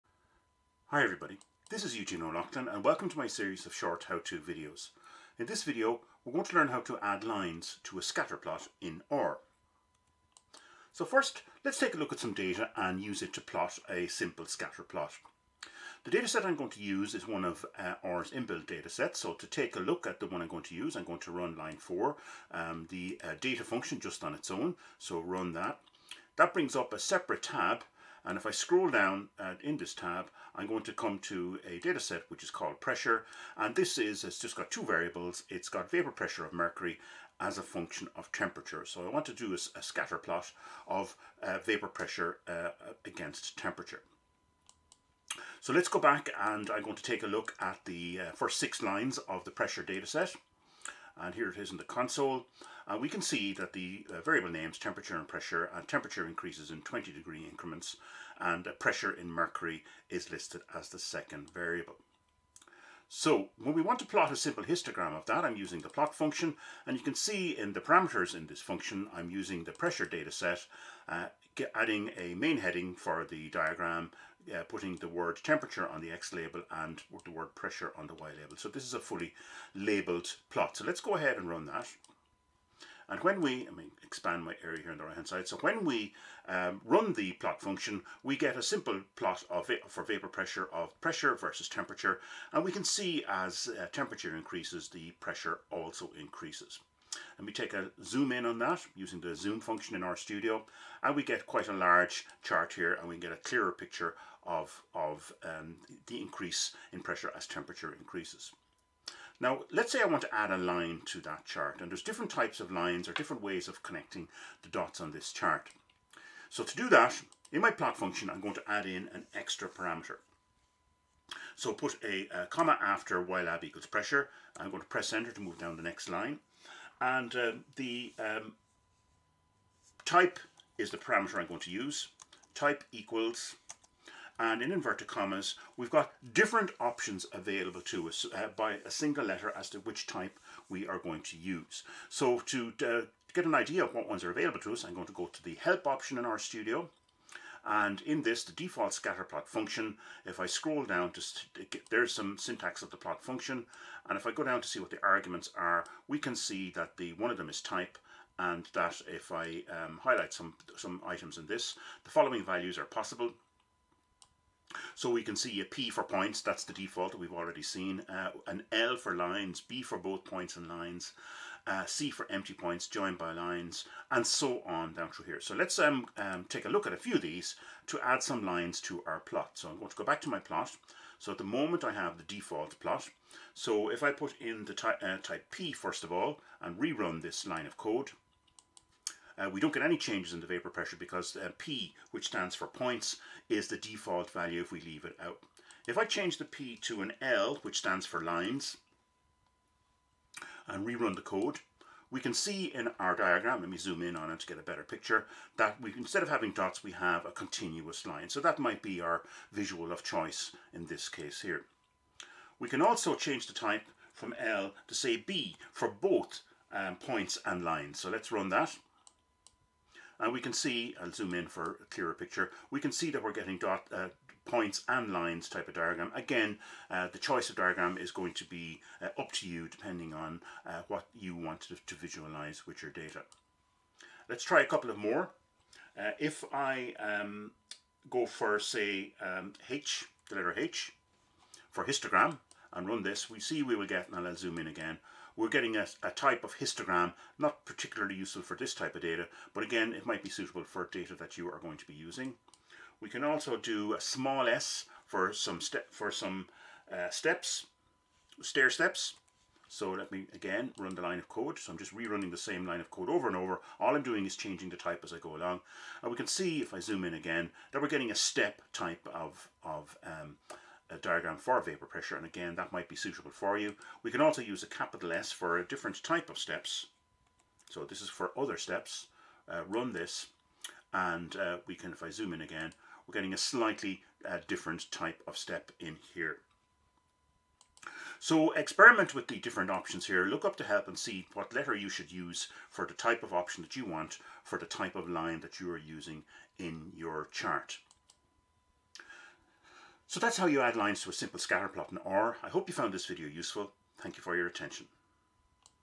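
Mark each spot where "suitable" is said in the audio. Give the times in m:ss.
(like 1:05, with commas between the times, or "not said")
4:10, 4:32.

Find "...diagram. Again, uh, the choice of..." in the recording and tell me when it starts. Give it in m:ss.
3:45.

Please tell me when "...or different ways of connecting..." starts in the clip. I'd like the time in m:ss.
1:53.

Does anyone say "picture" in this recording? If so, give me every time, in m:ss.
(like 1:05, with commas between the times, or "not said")
1:43, 3:24, 3:42.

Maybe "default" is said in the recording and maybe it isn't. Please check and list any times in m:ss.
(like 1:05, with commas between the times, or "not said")
2:28, 2:46, 3:02, 3:13.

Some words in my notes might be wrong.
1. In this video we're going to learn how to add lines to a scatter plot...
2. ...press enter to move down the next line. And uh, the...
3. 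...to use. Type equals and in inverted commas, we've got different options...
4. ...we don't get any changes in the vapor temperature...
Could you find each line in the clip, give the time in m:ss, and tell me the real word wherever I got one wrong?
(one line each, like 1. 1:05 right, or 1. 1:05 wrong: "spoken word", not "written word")
1. 0:05 right
2. 2:04 right
3. 2:11 right
4. 3:09 wrong: "pressure", not "temperature".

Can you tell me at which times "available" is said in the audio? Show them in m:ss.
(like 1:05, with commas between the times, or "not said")
2:17, 2:24.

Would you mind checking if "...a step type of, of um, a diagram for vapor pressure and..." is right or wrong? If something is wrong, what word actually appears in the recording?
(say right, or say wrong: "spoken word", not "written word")
right.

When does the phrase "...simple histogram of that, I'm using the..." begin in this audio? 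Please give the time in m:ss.
1:04.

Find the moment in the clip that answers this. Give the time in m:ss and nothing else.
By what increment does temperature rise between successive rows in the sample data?
0:56.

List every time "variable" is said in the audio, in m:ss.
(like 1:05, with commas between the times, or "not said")
0:34, 0:54, 1:01.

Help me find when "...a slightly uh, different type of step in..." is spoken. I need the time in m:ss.
4:43.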